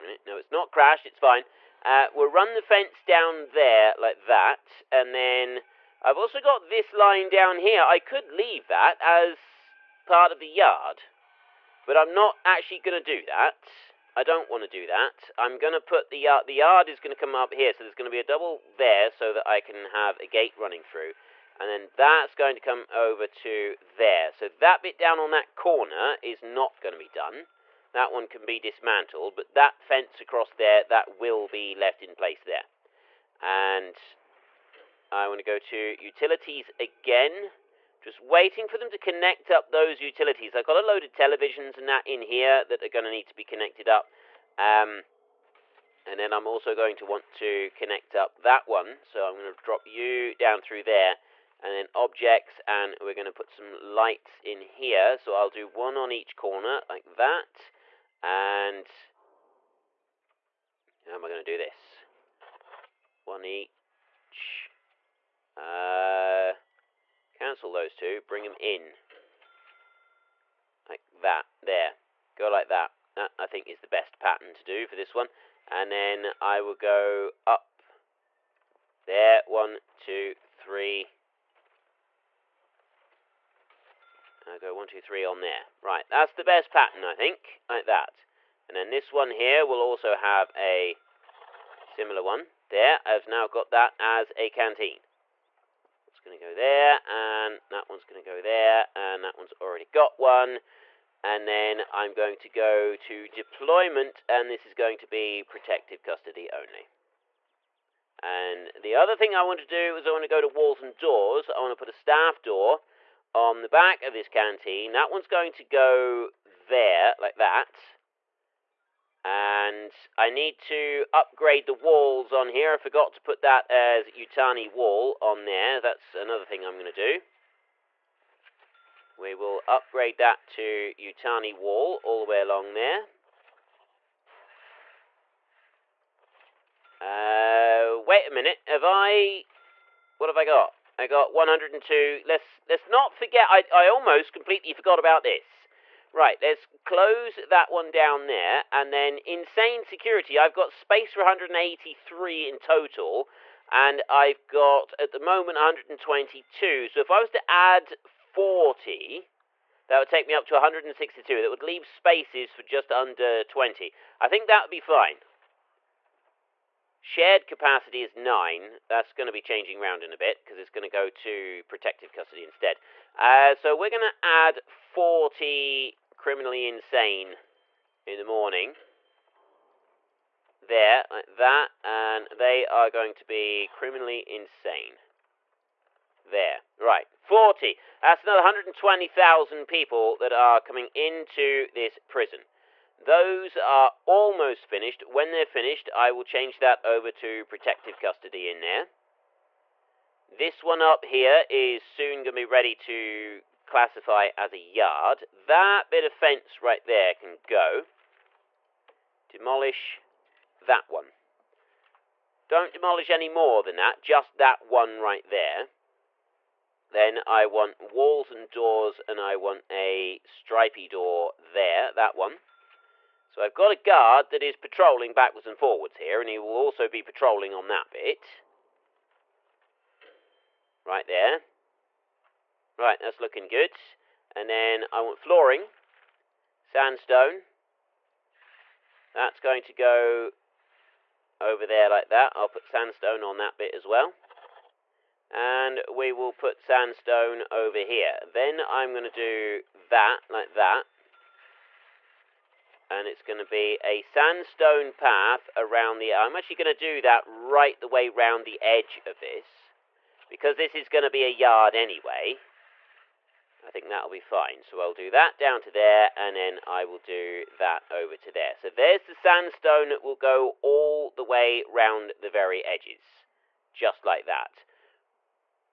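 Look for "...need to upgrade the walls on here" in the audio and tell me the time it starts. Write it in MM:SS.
02:00.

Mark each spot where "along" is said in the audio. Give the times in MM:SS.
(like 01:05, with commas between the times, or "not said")
02:12.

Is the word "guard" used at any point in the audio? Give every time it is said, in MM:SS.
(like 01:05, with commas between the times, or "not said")
03:43.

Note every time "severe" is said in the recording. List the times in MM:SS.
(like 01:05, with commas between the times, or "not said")
not said.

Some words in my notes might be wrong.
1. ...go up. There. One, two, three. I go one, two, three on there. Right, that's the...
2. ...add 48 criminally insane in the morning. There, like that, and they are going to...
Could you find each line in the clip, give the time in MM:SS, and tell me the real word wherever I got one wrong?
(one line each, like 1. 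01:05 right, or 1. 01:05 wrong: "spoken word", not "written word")
1. 01:16 right
2. 02:54 wrong: "40", not "48".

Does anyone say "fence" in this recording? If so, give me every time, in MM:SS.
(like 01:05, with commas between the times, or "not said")
00:02, 00:29, 03:26.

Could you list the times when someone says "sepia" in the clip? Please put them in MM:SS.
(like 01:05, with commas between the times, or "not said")
not said.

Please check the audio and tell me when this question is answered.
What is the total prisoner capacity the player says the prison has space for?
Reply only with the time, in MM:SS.
02:31.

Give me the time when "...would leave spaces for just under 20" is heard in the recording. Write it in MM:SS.
02:41.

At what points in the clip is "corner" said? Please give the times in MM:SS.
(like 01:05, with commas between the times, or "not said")
00:25, 00:56.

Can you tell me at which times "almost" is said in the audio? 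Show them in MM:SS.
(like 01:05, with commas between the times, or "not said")
02:23, 03:14.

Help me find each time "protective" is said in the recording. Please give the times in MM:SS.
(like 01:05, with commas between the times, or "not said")
01:45, 02:51, 03:17.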